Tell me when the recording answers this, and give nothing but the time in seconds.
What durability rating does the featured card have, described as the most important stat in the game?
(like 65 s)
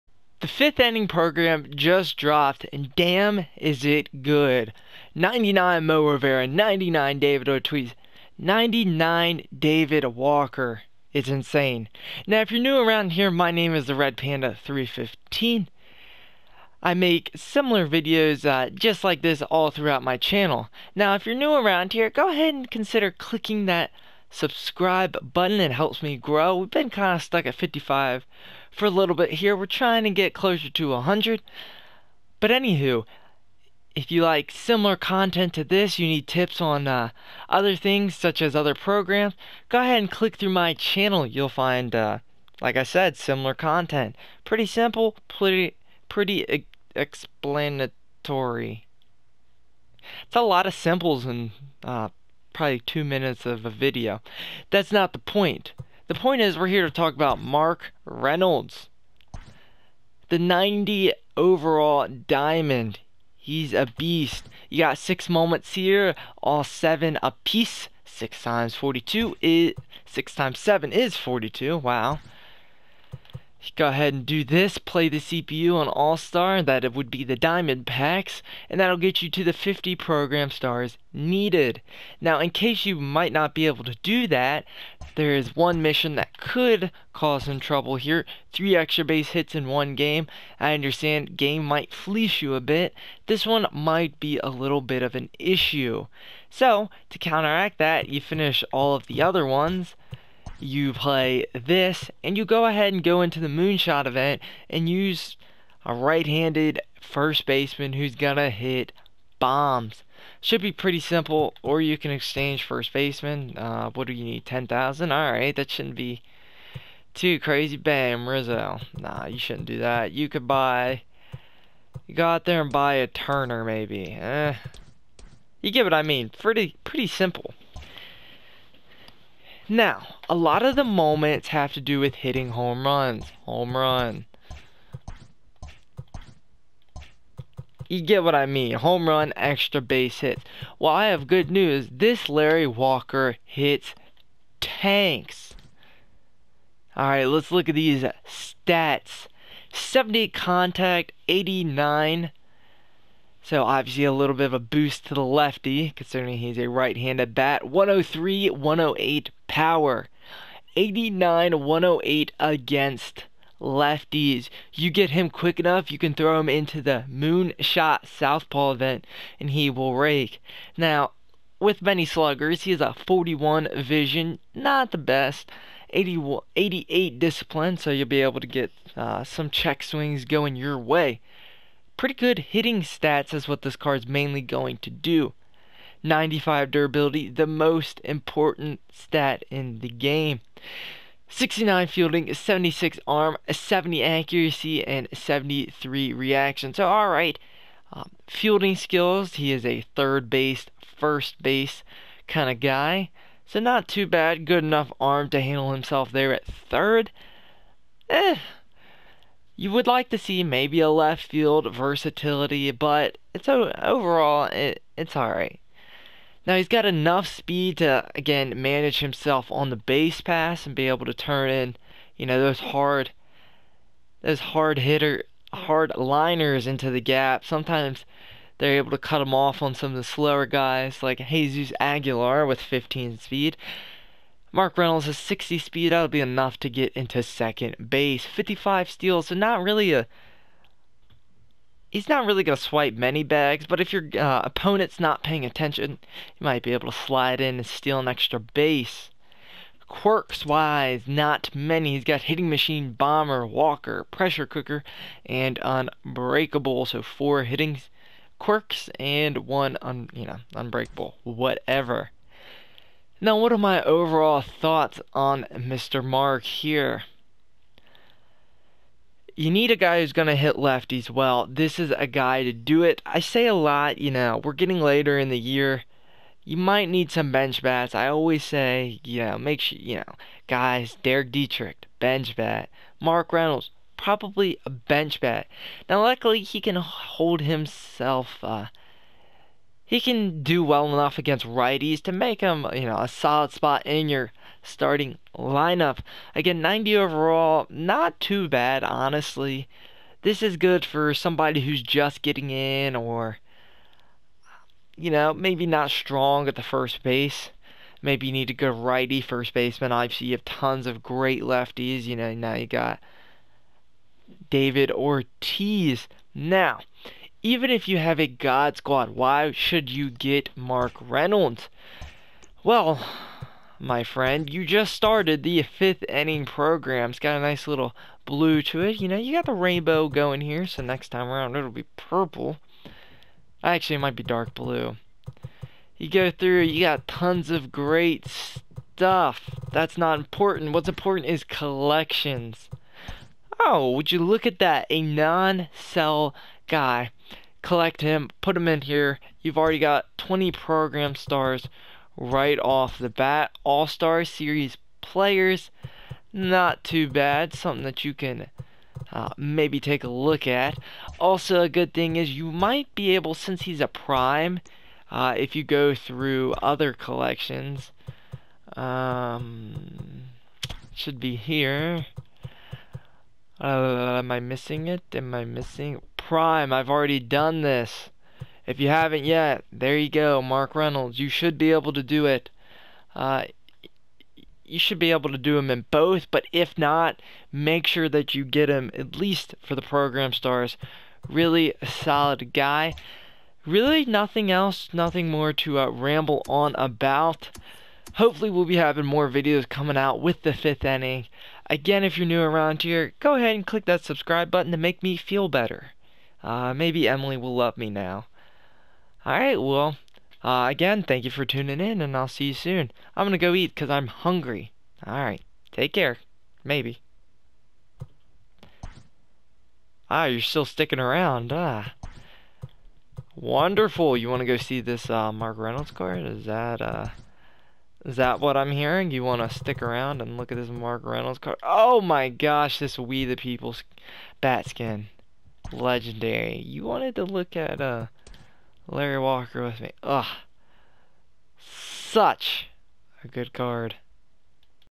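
186 s.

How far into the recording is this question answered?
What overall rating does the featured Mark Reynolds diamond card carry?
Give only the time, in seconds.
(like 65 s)
60 s.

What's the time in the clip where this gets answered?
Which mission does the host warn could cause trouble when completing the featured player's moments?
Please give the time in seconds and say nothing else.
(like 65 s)
88 s.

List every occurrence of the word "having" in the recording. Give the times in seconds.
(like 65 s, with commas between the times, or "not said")
398 s.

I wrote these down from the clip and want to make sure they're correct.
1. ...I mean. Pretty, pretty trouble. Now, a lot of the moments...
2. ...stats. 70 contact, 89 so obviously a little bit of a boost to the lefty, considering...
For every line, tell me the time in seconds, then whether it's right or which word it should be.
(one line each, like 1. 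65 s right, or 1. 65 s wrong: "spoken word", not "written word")
1. 125 s wrong: "simple", not "trouble"
2. 148 s right.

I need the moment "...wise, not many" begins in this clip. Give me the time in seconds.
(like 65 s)
250 s.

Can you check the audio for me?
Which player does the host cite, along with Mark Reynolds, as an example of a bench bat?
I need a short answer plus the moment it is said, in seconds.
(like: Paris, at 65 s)
Derek Dietrich, at 281 s.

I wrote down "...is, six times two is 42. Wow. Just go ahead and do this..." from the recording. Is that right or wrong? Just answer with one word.
wrong.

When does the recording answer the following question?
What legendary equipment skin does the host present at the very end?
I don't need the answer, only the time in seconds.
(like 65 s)
432 s.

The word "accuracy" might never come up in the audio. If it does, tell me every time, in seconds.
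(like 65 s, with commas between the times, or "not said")
194 s.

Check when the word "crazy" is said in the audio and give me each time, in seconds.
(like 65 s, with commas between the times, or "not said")
117 s.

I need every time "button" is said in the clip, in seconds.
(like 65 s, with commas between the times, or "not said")
25 s, 404 s.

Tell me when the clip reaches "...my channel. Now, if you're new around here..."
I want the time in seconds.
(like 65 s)
20 s.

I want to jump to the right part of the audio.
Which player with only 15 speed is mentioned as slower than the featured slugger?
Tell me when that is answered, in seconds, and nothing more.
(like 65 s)
231 s.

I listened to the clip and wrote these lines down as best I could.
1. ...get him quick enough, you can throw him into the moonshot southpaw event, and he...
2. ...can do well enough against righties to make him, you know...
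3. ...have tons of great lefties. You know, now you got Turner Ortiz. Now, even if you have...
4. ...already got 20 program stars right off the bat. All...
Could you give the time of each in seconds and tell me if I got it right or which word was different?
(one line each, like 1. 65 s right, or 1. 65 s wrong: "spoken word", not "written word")
1. 164 s right
2. 289 s right
3. 310 s wrong: "David", not "Turner"
4. 349 s right.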